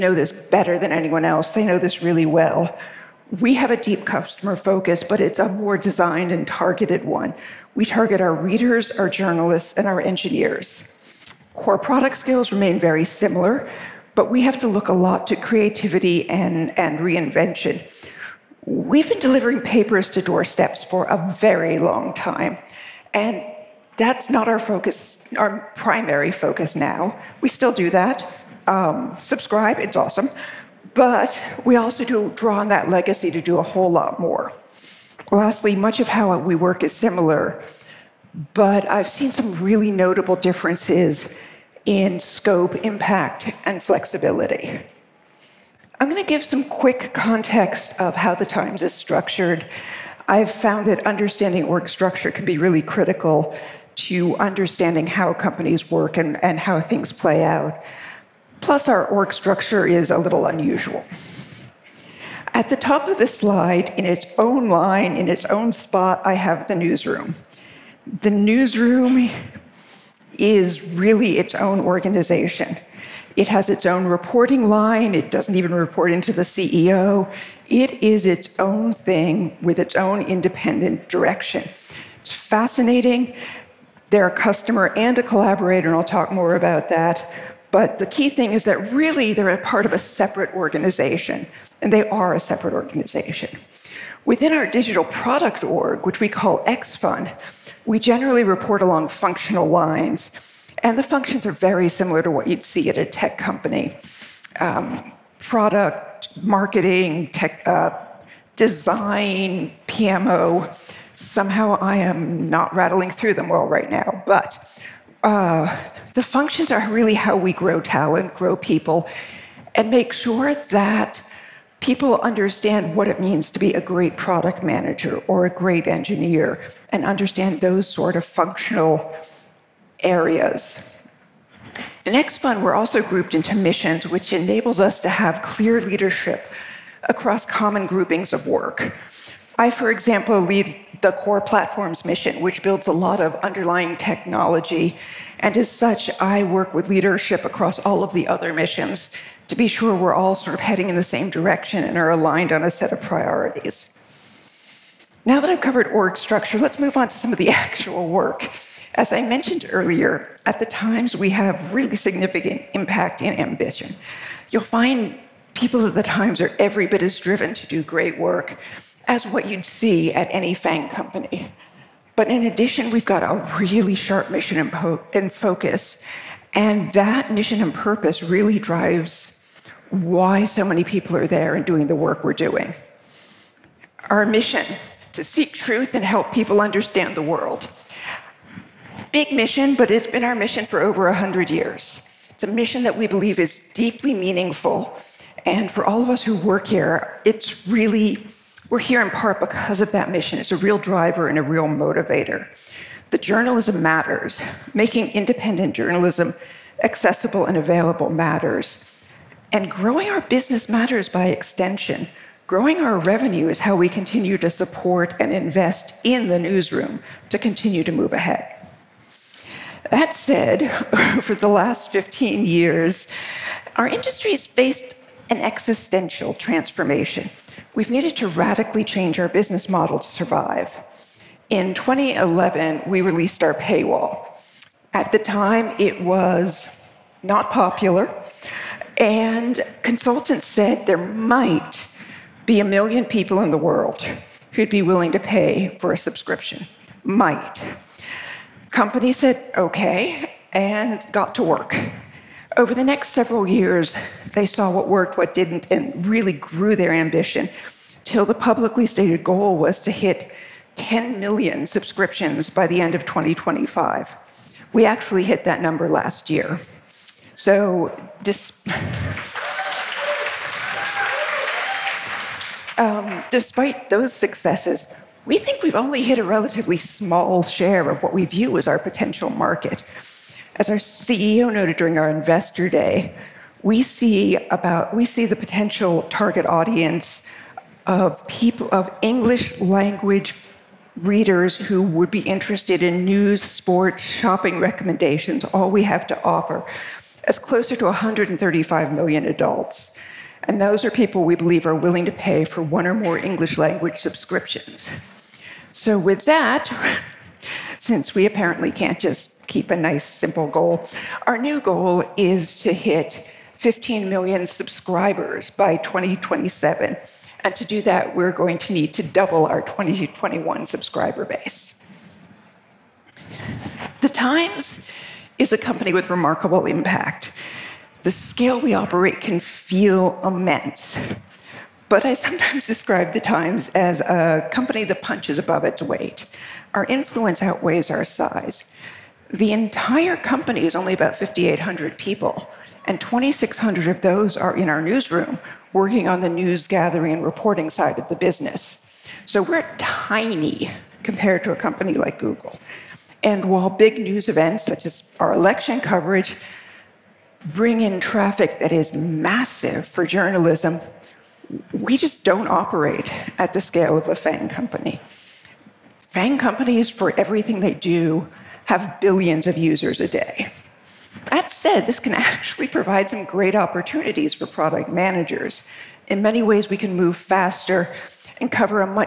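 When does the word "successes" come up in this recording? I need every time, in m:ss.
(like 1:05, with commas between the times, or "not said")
4:34.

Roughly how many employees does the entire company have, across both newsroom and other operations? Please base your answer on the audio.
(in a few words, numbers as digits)
5,800.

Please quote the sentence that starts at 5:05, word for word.
So, with that, since we apparently can't just keep a nice, simple goal.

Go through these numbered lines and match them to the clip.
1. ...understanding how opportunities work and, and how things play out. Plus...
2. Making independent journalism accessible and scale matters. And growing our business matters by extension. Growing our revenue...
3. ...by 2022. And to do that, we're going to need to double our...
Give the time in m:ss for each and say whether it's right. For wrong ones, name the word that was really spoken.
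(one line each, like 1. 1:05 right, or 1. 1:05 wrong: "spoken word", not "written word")
1. 0:54 wrong: "companies", not "opportunities"
2. 3:24 wrong: "available", not "scale"
3. 5:15 wrong: "2027", not "2022".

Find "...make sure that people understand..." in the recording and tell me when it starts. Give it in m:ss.
1:59.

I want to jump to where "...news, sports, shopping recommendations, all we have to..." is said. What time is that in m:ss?
4:53.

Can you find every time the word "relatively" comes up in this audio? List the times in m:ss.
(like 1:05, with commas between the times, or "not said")
4:36.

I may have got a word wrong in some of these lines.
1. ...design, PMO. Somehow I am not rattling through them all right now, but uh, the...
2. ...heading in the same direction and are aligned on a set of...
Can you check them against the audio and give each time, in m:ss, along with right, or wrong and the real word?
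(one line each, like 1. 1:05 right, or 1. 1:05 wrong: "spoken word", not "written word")
1. 1:48 right
2. 2:30 right.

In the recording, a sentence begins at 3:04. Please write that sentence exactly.
Our mission to seek truth and help people understand the world.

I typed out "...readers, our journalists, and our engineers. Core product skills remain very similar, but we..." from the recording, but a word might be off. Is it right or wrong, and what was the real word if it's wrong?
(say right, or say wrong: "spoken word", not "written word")
right.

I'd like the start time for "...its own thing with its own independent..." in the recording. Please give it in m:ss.
1:18.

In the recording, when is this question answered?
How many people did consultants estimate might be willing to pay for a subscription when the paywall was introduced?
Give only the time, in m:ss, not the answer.
4:02.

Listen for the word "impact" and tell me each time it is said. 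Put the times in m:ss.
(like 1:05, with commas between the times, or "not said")
0:42, 2:42, 5:26.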